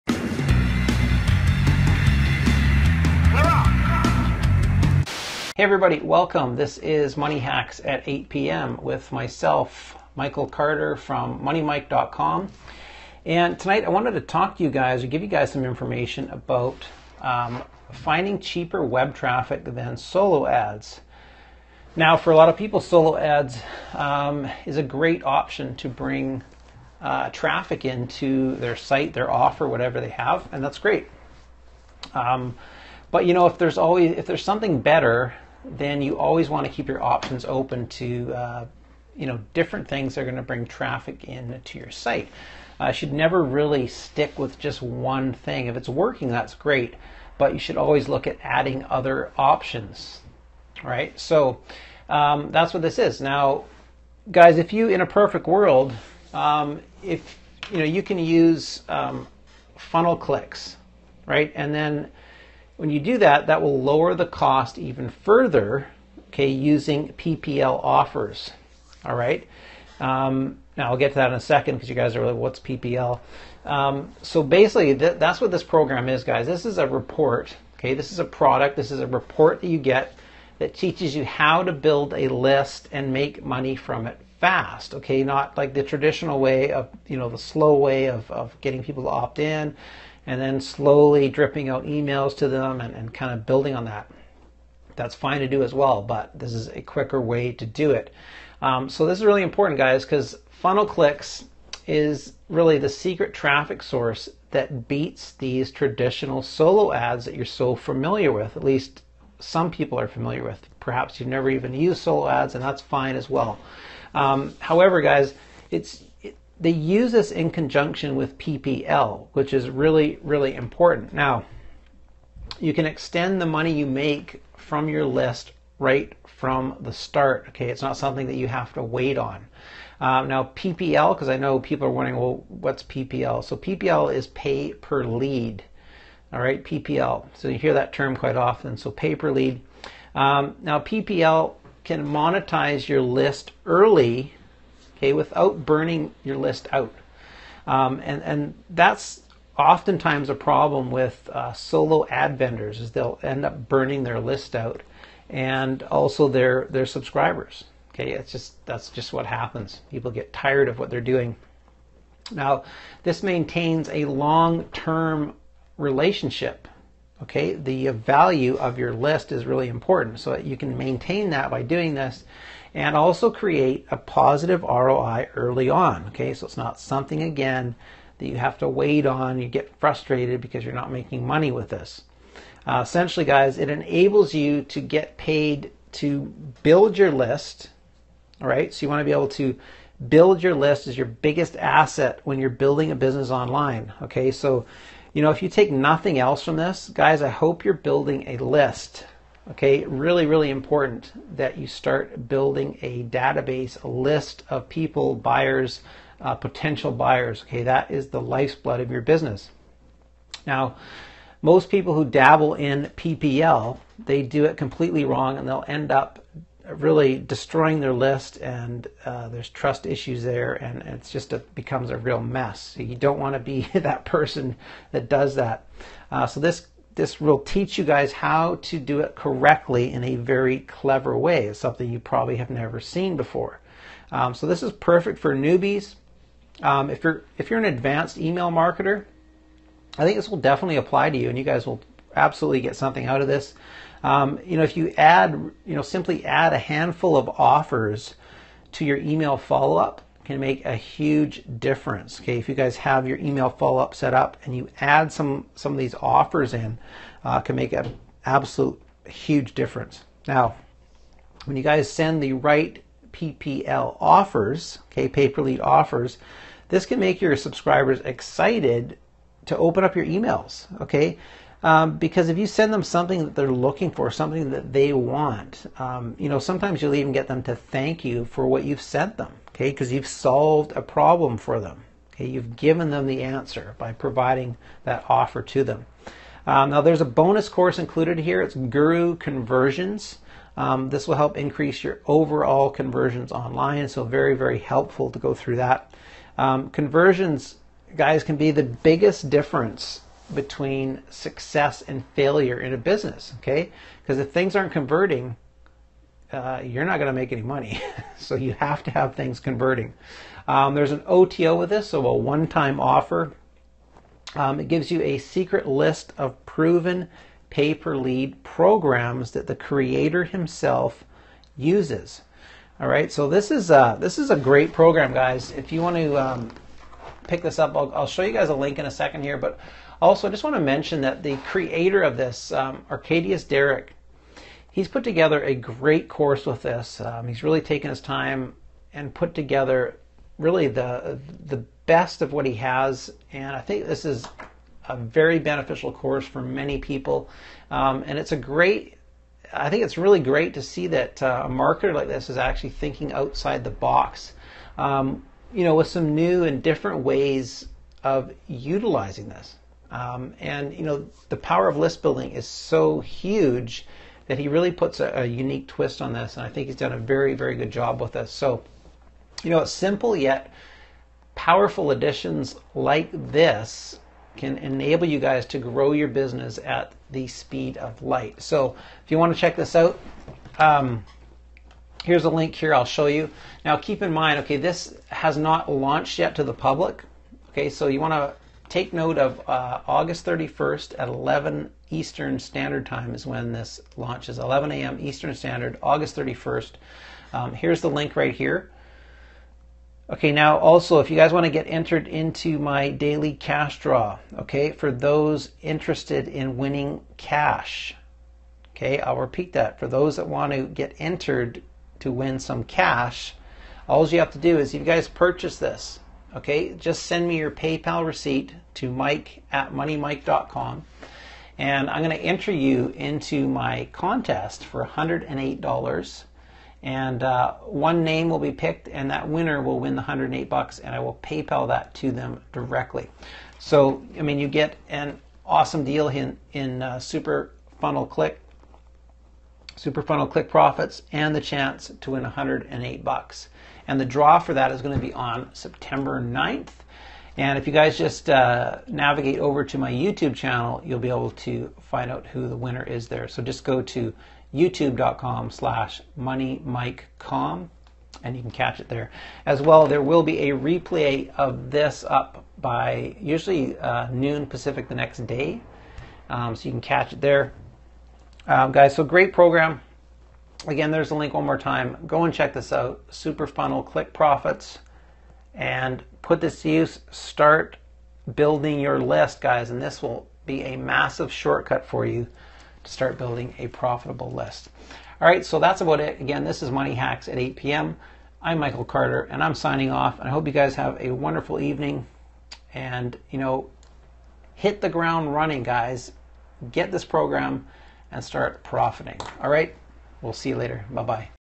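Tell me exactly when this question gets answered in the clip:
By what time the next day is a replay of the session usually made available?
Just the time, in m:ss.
7:44.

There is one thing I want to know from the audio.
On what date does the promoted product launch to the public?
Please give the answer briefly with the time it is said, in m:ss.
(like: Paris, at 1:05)
August 31st, at 6:29.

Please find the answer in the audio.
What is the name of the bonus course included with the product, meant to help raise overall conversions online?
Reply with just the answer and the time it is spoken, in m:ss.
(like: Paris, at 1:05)
Guru Conversions, at 4:48.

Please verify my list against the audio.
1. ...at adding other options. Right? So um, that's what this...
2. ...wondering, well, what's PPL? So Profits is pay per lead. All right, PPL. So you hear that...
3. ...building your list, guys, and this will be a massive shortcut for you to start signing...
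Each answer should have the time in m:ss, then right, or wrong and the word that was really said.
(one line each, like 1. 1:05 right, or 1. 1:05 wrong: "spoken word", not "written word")
1. 0:48 right
2. 2:11 wrong: "PPL", not "Profits"
3. 7:58 wrong: "building", not "signing".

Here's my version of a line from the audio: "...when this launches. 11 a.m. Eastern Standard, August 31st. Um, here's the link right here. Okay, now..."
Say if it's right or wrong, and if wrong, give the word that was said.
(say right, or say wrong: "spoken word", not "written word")
right.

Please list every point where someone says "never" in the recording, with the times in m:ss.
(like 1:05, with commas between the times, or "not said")
0:43, 1:51, 3:52.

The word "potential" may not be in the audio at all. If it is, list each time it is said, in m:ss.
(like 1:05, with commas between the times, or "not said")
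3:26.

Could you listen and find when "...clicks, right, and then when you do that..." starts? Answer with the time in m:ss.
1:00.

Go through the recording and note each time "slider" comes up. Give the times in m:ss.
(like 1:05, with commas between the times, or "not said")
not said.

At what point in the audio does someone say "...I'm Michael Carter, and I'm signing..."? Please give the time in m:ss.
8:08.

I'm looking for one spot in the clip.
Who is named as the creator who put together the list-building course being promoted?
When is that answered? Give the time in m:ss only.
5:32.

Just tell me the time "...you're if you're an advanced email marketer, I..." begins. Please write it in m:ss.
3:57.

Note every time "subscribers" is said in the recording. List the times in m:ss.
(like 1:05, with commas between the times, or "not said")
2:36, 4:27.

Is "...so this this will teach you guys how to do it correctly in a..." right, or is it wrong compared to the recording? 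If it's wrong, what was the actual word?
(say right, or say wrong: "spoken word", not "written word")
right.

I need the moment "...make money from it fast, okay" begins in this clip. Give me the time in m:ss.
1:23.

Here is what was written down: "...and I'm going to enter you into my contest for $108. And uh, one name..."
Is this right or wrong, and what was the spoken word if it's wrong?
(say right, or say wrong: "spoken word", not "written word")
right.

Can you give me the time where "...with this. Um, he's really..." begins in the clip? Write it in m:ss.
5:36.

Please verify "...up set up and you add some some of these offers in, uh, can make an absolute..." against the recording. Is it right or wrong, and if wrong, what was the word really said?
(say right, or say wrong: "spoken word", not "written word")
right.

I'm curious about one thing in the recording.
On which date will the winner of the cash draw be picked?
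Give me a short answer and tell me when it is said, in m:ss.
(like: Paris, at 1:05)
September 9th, at 7:25.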